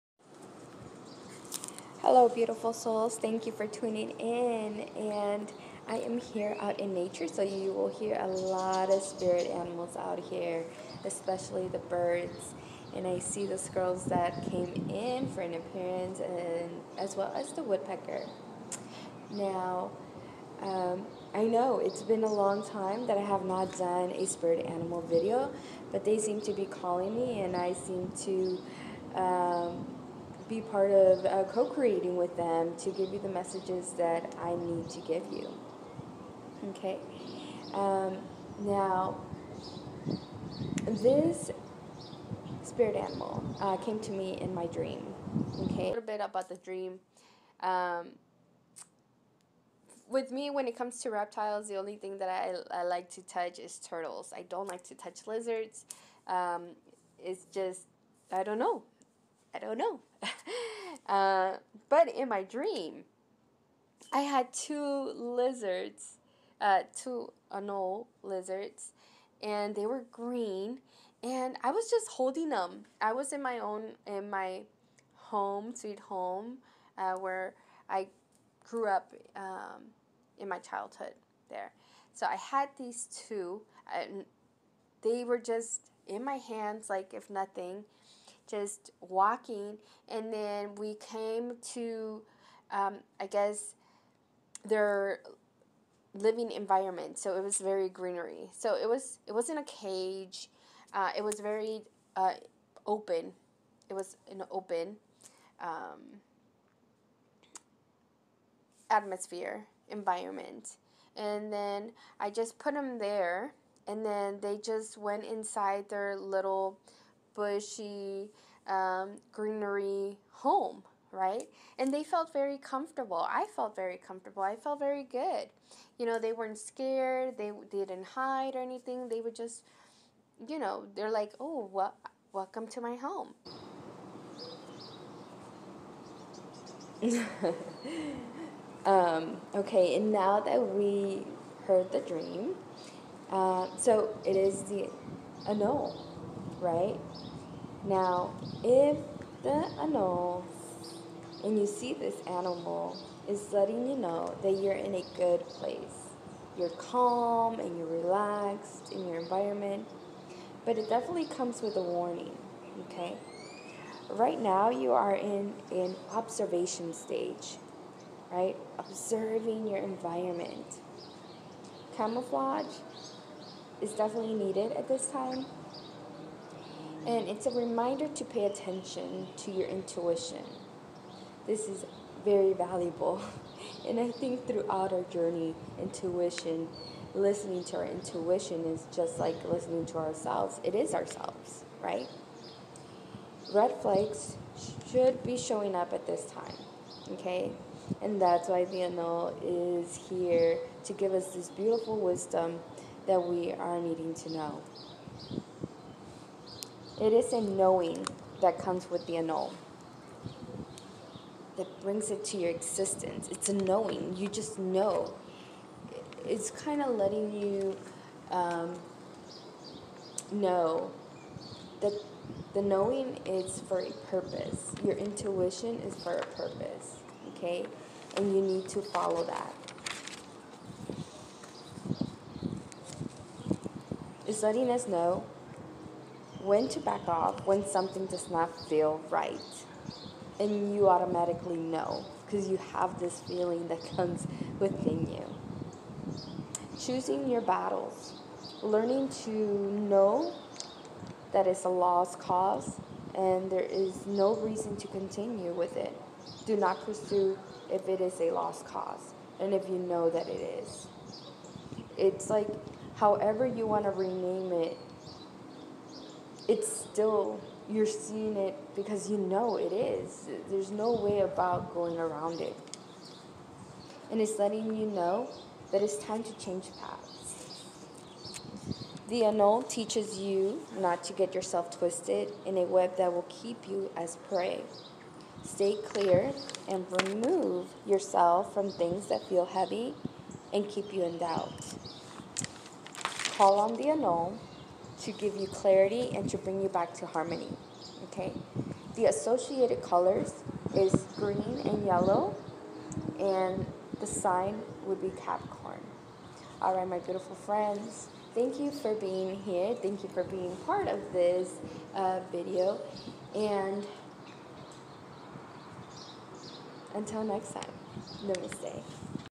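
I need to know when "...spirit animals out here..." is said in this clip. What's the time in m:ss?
0:09.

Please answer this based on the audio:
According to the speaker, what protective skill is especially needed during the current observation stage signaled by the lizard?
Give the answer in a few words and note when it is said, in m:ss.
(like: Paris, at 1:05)
Camouflage, at 2:51.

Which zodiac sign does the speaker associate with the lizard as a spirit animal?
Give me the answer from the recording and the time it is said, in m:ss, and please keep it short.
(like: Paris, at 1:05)
Capricorn, at 5:05.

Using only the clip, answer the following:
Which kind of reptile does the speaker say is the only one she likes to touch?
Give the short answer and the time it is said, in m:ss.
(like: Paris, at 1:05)
Turtles, at 0:53.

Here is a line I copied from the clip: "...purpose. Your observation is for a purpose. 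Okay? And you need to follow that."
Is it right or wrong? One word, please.
wrong.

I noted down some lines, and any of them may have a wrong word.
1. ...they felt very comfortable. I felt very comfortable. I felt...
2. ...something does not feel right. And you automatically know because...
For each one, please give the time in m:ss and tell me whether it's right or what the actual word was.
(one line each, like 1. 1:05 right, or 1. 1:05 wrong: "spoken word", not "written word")
1. 2:01 right
2. 3:57 right.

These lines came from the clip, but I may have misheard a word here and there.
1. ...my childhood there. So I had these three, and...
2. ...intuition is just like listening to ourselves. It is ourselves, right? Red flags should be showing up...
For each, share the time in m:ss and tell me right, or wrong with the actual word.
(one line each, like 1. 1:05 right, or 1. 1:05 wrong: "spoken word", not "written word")
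1. 1:20 wrong: "two", not "three"
2. 3:07 right.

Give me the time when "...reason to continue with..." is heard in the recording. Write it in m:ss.
4:14.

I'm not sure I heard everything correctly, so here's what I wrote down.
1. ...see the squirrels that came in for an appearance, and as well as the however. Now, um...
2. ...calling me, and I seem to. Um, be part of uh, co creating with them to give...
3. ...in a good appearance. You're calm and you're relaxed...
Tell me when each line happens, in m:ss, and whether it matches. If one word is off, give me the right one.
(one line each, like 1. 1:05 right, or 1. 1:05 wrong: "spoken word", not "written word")
1. 0:13 wrong: "woodpecker", not "however"
2. 0:26 right
3. 2:34 wrong: "place", not "appearance".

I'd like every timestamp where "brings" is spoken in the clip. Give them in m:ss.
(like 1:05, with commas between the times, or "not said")
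3:31, 4:56.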